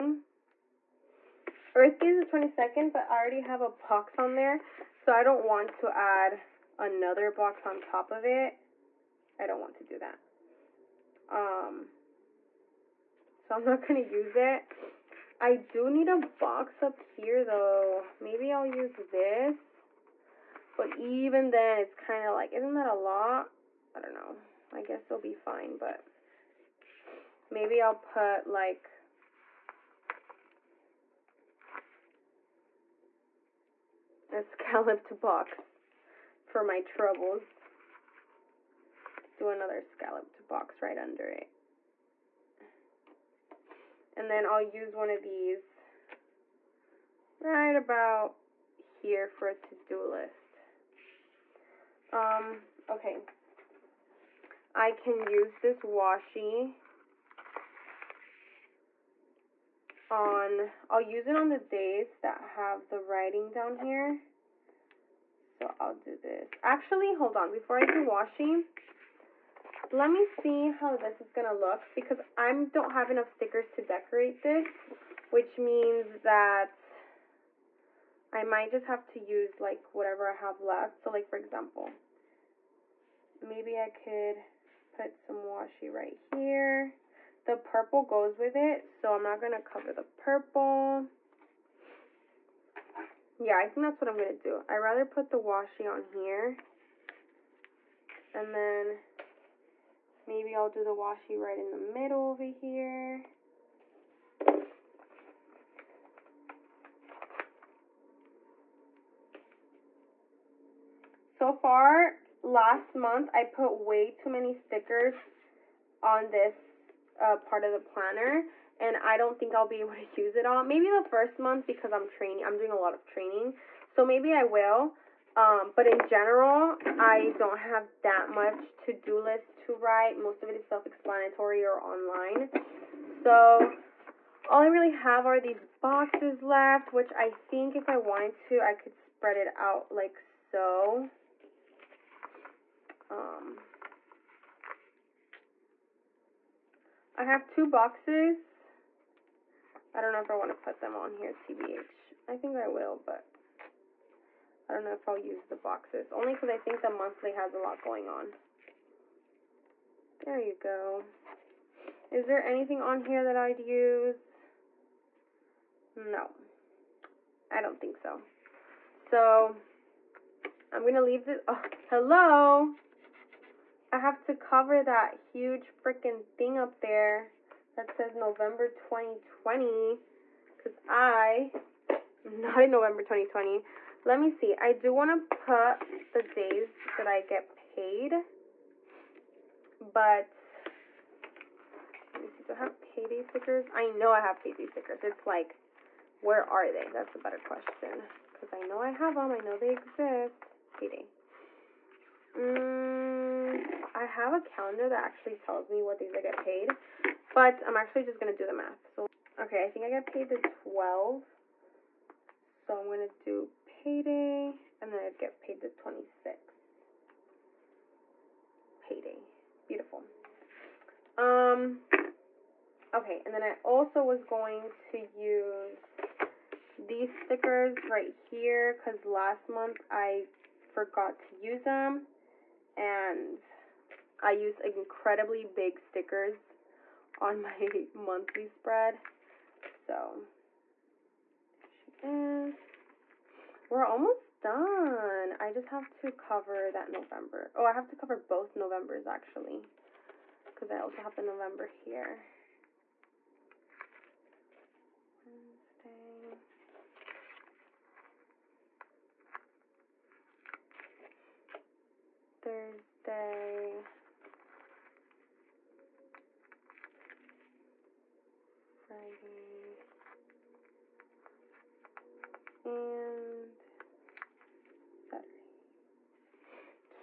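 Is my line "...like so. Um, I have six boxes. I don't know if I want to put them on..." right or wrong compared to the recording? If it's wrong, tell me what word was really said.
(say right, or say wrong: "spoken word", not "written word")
wrong: "two", not "six".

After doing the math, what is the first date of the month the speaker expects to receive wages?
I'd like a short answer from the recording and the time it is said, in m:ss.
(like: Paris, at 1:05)
12th, at 3:30.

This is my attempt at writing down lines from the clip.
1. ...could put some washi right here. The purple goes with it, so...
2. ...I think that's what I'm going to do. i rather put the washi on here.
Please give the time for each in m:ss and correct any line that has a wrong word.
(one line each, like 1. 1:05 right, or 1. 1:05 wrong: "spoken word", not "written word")
1. 1:23 right
2. 1:33 right.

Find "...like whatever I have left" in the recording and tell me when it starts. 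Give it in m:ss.
1:19.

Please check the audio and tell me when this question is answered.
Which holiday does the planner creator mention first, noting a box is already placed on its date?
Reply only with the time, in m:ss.
0:01.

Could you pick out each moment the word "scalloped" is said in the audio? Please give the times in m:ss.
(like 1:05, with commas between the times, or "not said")
0:34, 0:39.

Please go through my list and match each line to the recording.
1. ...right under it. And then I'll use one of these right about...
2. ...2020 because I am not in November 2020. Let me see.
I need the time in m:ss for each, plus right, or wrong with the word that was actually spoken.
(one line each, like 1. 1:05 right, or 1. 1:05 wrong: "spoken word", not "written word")
1. 0:40 right
2. 2:58 right.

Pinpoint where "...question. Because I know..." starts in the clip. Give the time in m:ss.
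3:17.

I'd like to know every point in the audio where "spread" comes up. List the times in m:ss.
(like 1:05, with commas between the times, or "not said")
2:18, 3:58.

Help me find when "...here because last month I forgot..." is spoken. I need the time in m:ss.
3:48.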